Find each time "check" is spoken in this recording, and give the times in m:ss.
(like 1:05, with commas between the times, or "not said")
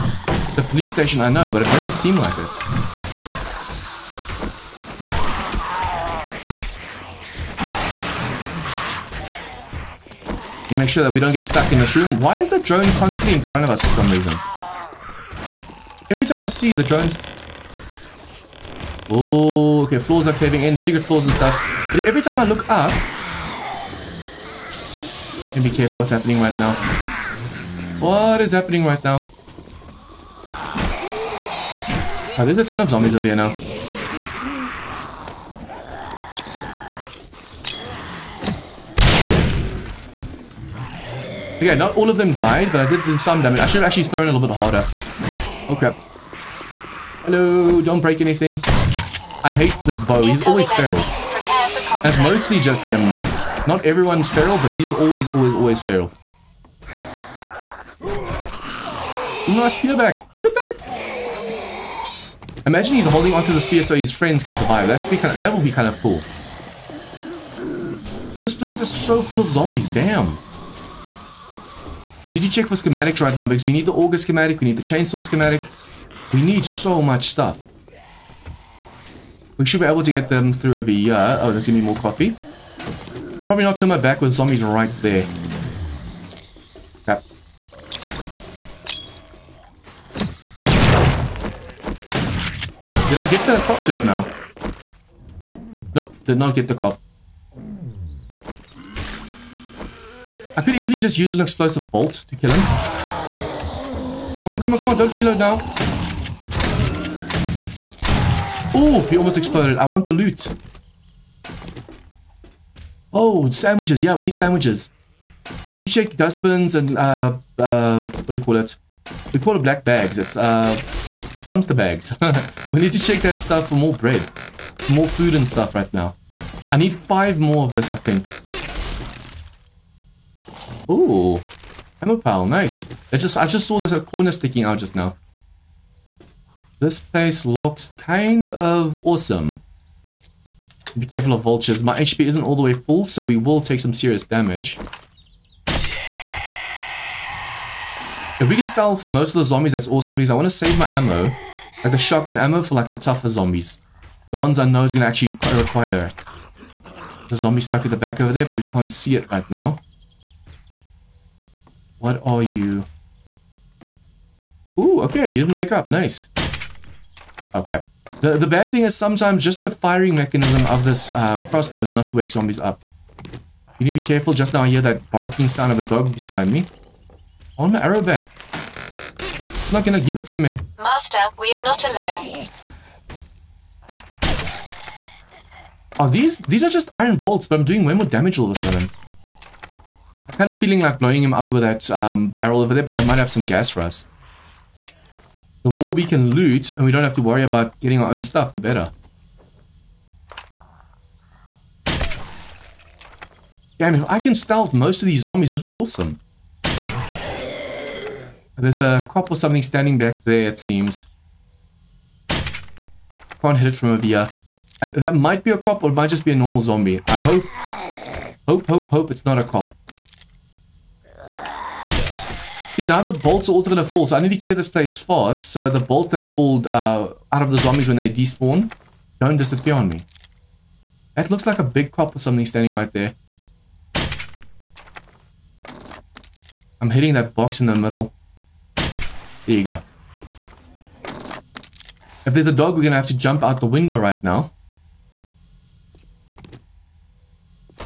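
1:12, 1:55, 2:02.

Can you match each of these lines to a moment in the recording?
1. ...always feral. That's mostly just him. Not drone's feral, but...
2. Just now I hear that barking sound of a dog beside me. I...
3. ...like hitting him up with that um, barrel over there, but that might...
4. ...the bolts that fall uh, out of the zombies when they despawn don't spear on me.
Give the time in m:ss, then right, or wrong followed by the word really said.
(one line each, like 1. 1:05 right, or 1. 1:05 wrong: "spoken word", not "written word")
1. 0:50 wrong: "everyone", not "drone"
2. 2:54 right
3. 3:10 wrong: "blowing", not "hitting"
4. 3:45 wrong: "disappear", not "spear".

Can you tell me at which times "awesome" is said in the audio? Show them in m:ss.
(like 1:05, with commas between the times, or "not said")
2:19, 2:29, 3:25.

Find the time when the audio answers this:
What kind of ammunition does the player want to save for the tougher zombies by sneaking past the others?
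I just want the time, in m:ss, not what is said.
2:31.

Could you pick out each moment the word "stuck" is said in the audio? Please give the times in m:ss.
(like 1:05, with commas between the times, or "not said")
0:11, 2:37.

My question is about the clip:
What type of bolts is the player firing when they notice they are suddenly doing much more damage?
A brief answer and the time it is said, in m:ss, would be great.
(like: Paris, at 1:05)
iron bolts, at 3:06.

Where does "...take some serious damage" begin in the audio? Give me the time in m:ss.
2:23.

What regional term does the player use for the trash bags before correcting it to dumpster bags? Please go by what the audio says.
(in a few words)
black bags.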